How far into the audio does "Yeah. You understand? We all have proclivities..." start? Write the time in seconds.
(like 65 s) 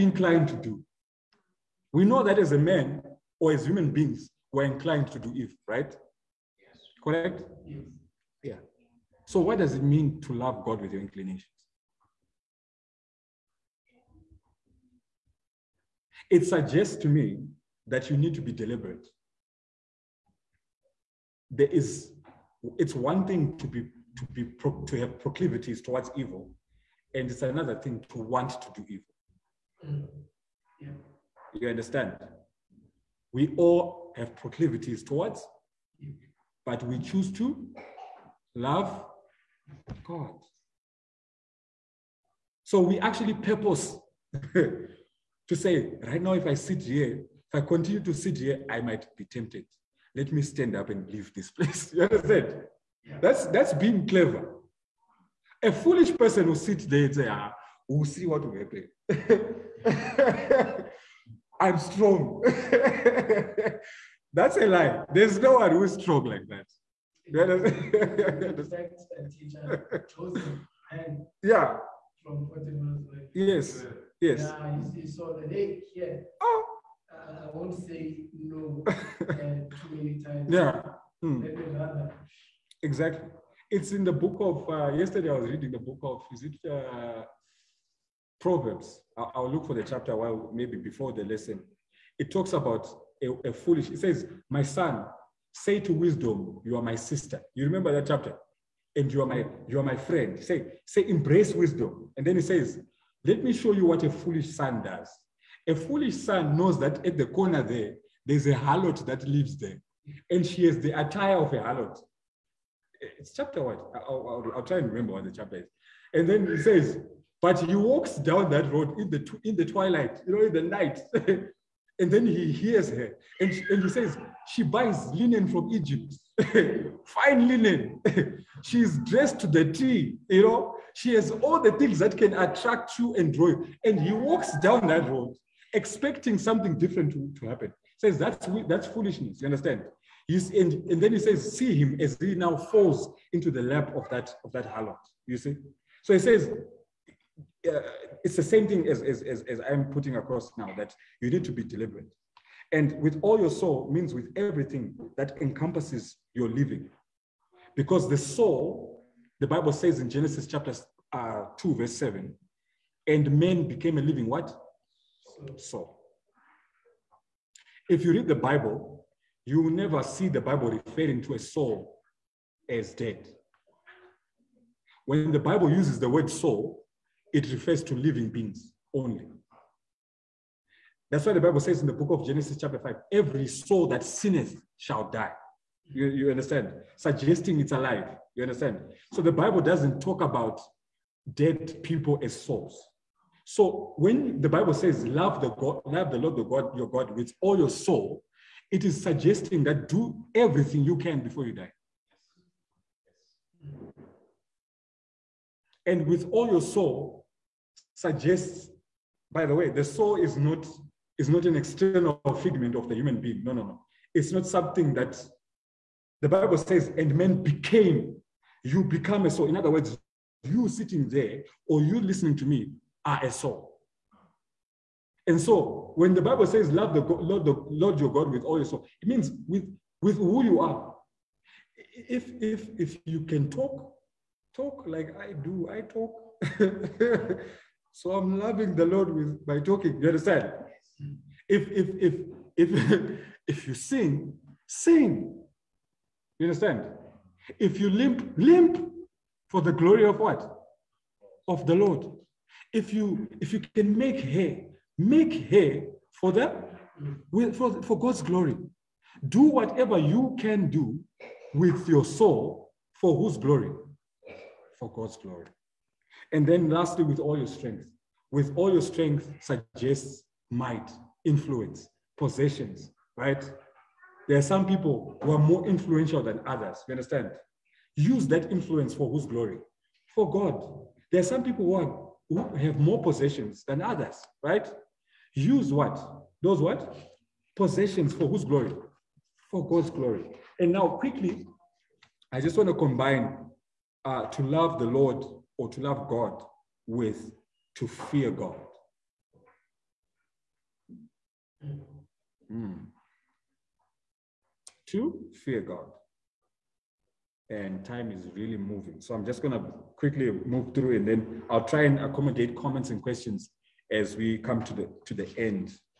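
30 s.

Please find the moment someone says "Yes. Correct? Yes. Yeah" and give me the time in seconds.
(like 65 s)
6 s.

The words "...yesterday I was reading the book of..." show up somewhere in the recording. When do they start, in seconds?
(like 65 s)
84 s.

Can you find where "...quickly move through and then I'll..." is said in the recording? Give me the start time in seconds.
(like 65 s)
309 s.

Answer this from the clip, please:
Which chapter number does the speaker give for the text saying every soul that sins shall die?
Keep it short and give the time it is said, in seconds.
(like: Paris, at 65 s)
5, at 182 s.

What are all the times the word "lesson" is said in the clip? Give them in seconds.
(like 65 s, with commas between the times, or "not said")
91 s.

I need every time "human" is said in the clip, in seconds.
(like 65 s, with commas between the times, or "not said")
3 s, 212 s.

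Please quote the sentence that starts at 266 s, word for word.
And then lastly, with all your strength.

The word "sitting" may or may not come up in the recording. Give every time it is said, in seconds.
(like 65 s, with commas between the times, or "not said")
220 s.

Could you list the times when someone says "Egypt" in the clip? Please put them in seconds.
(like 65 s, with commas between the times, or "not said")
125 s.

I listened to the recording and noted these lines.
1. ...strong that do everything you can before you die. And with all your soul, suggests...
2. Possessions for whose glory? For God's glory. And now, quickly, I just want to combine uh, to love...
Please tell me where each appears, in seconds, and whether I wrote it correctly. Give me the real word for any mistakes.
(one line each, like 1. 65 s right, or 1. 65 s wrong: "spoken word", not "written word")
1. 199 s wrong: "suggesting", not "strong"
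2. 287 s right.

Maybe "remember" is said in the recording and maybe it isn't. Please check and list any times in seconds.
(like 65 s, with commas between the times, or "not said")
97 s, 114 s.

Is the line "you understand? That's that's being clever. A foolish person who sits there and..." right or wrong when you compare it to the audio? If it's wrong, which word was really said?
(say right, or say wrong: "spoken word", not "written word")
right.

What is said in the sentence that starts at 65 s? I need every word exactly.
There's no one who's strong like that.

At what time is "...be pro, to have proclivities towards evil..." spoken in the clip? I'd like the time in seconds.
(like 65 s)
24 s.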